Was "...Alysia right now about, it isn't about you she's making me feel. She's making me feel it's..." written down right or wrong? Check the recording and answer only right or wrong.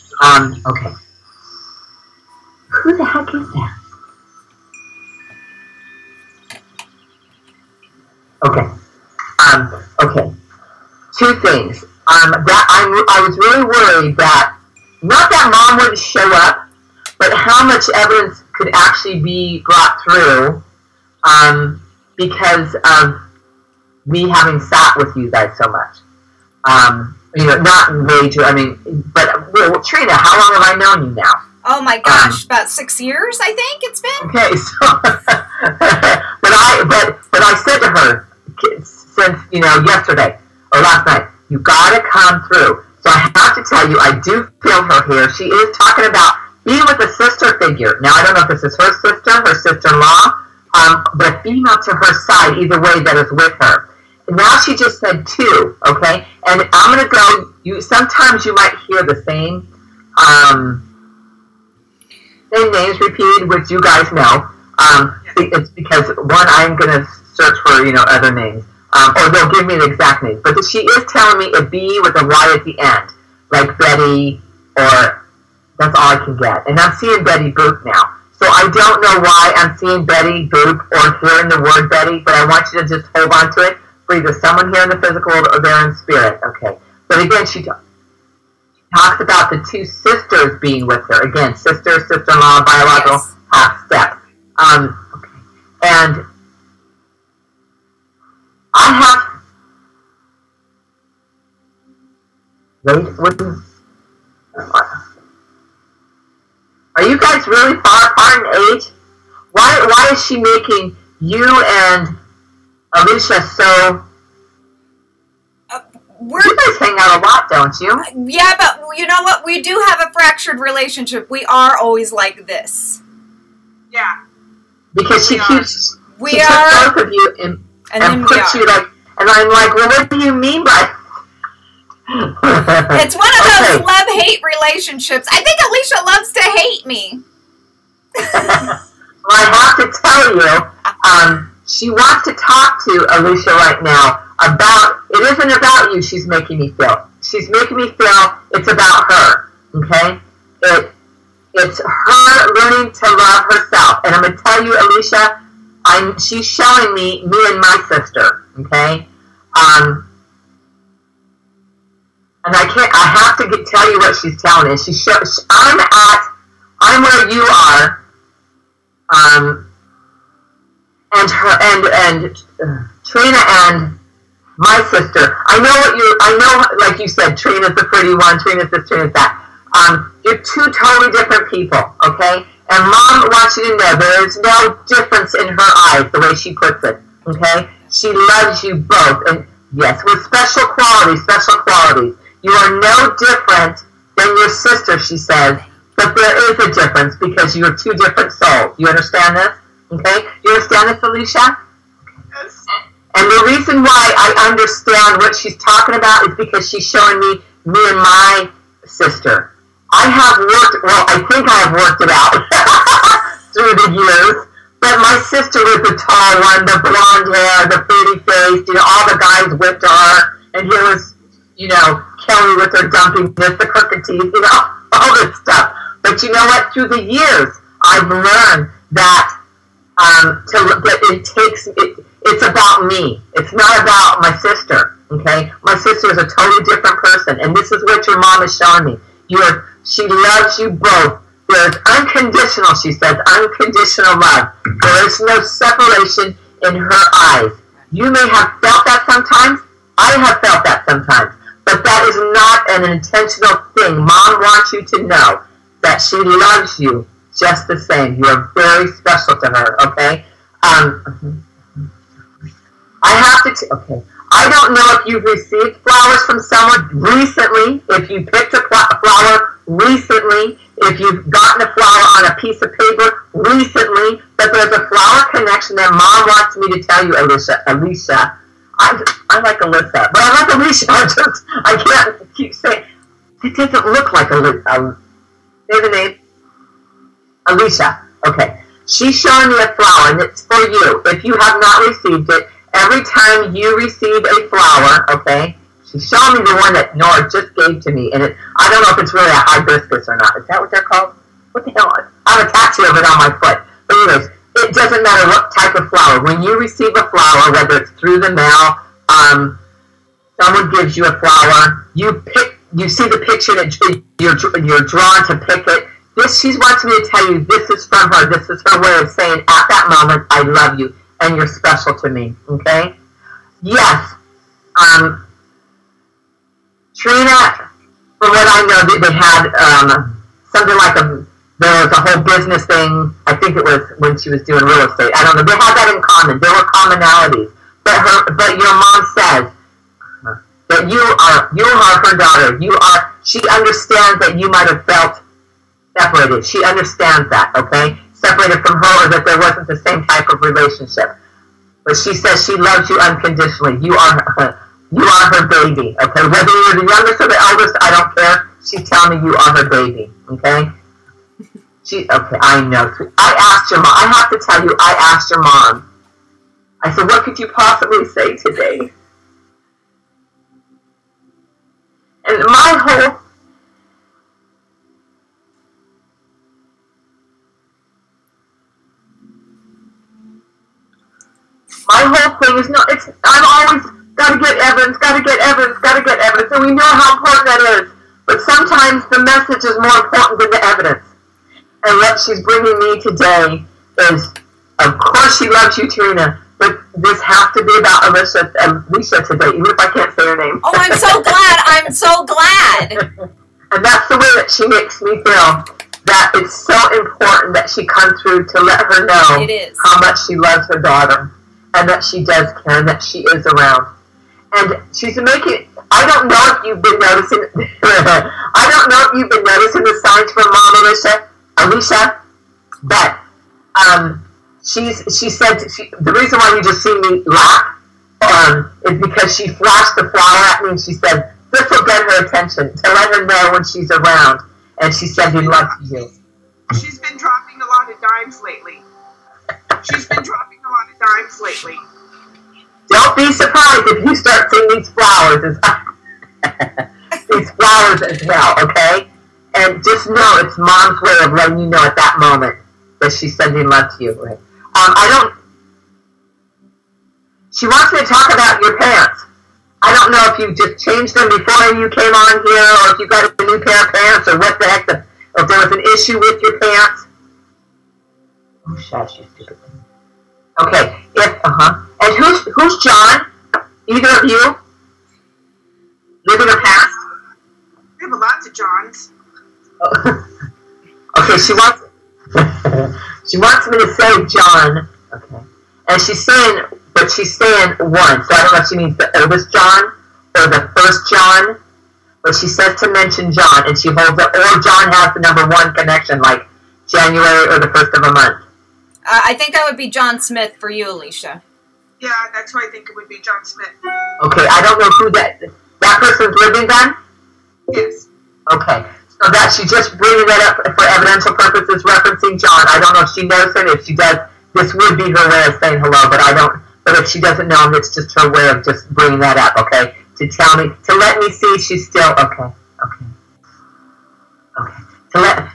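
right.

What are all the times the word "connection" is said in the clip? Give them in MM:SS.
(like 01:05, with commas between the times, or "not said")
04:35, 08:15.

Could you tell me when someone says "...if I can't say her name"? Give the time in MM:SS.
06:39.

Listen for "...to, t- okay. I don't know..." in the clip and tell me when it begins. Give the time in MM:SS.
04:23.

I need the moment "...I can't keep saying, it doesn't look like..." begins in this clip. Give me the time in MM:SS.
04:41.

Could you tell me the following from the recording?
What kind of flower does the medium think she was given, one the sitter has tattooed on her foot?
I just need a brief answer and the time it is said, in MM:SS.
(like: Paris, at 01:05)
hibiscus, at 04:59.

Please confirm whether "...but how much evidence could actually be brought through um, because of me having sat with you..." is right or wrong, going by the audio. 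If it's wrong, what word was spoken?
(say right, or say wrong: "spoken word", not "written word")
right.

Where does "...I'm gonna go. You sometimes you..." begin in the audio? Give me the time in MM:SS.
00:56.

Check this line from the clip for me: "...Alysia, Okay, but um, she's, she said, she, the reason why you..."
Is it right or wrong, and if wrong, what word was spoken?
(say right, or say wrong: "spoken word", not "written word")
wrong: "Alysia", not "Okay".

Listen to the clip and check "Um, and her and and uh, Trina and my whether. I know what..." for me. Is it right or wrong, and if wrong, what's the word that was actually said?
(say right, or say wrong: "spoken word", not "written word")
wrong: "sister", not "whether".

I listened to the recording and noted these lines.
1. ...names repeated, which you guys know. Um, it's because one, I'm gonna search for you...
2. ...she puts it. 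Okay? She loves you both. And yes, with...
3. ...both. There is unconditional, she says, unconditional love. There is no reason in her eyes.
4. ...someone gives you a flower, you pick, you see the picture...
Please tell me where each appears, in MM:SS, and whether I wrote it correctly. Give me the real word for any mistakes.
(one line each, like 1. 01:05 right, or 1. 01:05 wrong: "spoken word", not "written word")
1. 01:02 right
2. 03:06 right
3. 04:00 wrong: "separation", not "reason"
4. 05:10 right.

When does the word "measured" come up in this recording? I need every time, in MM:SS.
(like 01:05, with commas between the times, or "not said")
not said.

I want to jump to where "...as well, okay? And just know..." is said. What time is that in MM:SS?
07:28.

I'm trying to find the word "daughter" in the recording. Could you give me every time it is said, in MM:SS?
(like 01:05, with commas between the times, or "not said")
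05:42, 06:50.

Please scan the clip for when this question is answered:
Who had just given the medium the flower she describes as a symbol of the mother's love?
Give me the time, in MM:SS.
04:56.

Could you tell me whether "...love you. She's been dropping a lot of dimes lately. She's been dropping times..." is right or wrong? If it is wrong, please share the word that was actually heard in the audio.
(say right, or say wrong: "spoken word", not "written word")
right.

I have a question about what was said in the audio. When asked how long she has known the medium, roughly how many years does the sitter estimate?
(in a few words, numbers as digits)
6 years.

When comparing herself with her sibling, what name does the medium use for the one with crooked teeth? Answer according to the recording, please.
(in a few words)
Kelly.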